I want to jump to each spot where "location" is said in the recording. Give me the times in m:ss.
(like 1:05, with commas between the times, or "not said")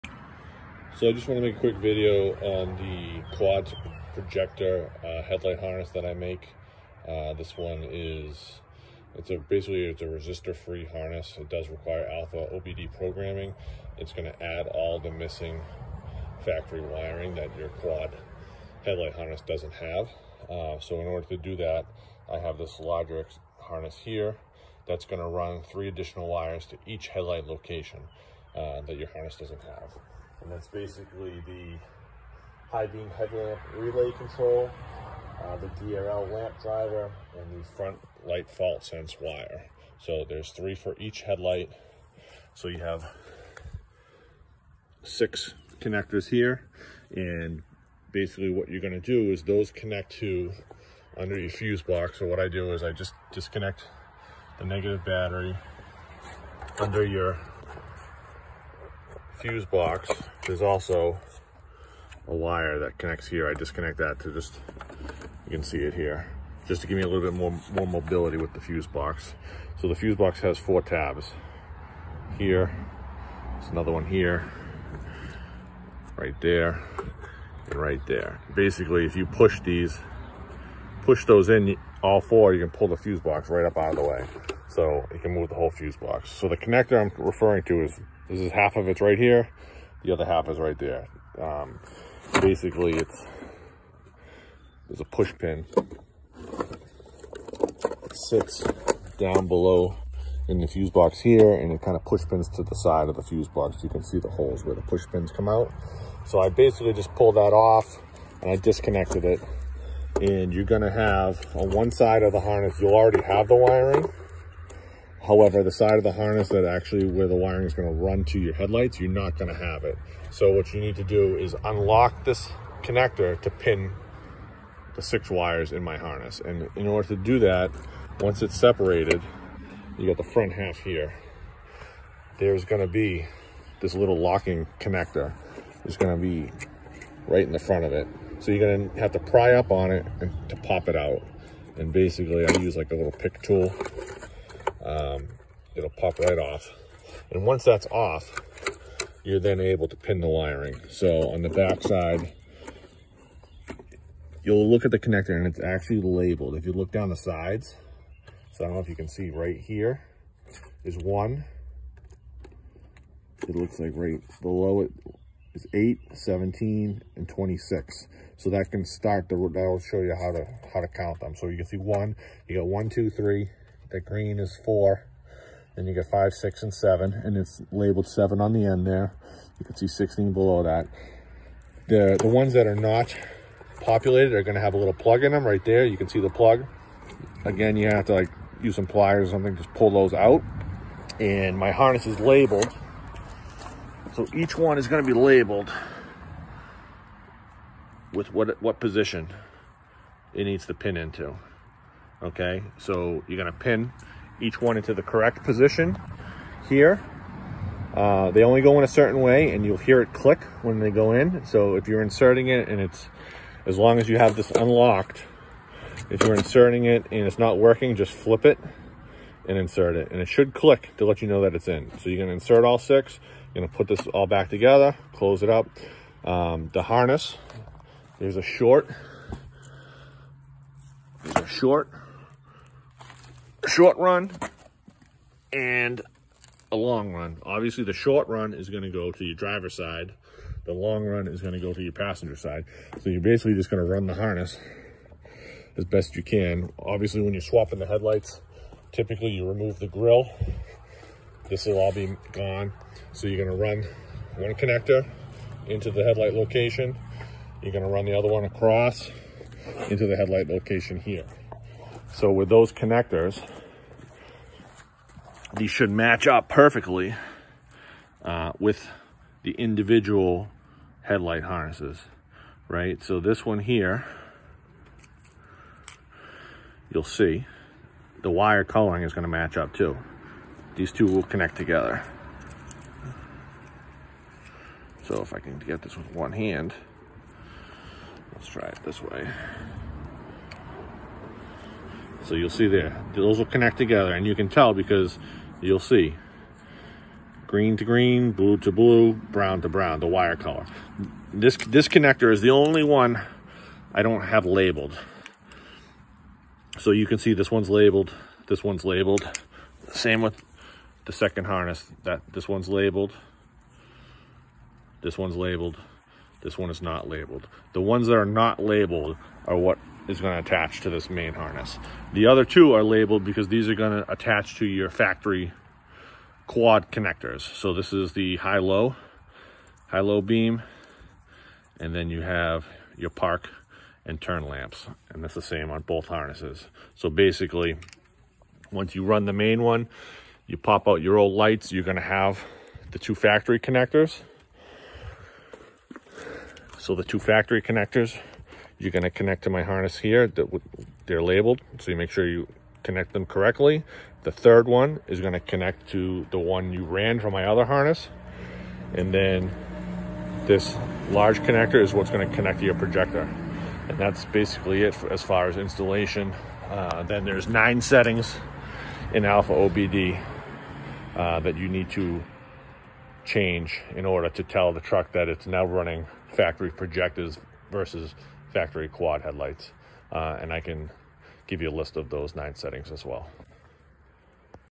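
0:27, 4:16, 4:20.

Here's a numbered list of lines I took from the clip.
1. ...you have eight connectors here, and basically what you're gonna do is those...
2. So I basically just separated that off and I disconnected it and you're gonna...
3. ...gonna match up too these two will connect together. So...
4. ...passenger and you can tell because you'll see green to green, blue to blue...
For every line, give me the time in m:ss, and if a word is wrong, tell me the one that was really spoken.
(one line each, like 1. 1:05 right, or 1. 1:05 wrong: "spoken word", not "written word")
1. 0:42 wrong: "six", not "eight"
2. 1:46 wrong: "pulled", not "separated"
3. 4:39 right
4. 4:53 wrong: "together", not "passenger".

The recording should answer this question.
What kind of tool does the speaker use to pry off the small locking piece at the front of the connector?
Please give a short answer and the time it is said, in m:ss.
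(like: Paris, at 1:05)
pick tool, at 2:22.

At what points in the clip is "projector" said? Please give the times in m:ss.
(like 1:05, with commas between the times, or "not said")
0:04, 6:02, 6:16.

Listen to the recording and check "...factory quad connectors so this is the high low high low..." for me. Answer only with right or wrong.
right.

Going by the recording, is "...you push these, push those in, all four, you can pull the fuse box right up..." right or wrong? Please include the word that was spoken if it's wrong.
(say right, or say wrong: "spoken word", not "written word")
right.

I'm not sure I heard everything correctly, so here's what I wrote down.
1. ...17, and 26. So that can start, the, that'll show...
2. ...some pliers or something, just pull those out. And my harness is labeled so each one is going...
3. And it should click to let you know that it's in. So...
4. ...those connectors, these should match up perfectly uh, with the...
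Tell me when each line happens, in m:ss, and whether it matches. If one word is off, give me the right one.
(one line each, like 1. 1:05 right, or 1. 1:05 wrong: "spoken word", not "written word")
1. 2:46 right
2. 3:08 right
3. 3:40 right
4. 4:22 right.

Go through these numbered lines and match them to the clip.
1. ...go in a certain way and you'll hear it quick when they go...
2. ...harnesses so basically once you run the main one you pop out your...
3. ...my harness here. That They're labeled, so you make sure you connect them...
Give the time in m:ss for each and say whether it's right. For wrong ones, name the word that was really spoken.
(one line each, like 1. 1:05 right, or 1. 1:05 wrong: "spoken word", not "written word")
1. 3:28 wrong: "click", not "quick"
2. 5:36 right
3. 5:49 right.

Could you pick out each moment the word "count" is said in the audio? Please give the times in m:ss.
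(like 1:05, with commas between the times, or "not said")
2:50.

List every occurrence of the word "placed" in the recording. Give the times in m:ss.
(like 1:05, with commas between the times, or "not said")
not said.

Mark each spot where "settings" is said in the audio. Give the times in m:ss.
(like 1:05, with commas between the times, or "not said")
6:07, 6:22.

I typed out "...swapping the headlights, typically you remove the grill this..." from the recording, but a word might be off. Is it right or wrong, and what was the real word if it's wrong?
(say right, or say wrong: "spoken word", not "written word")
right.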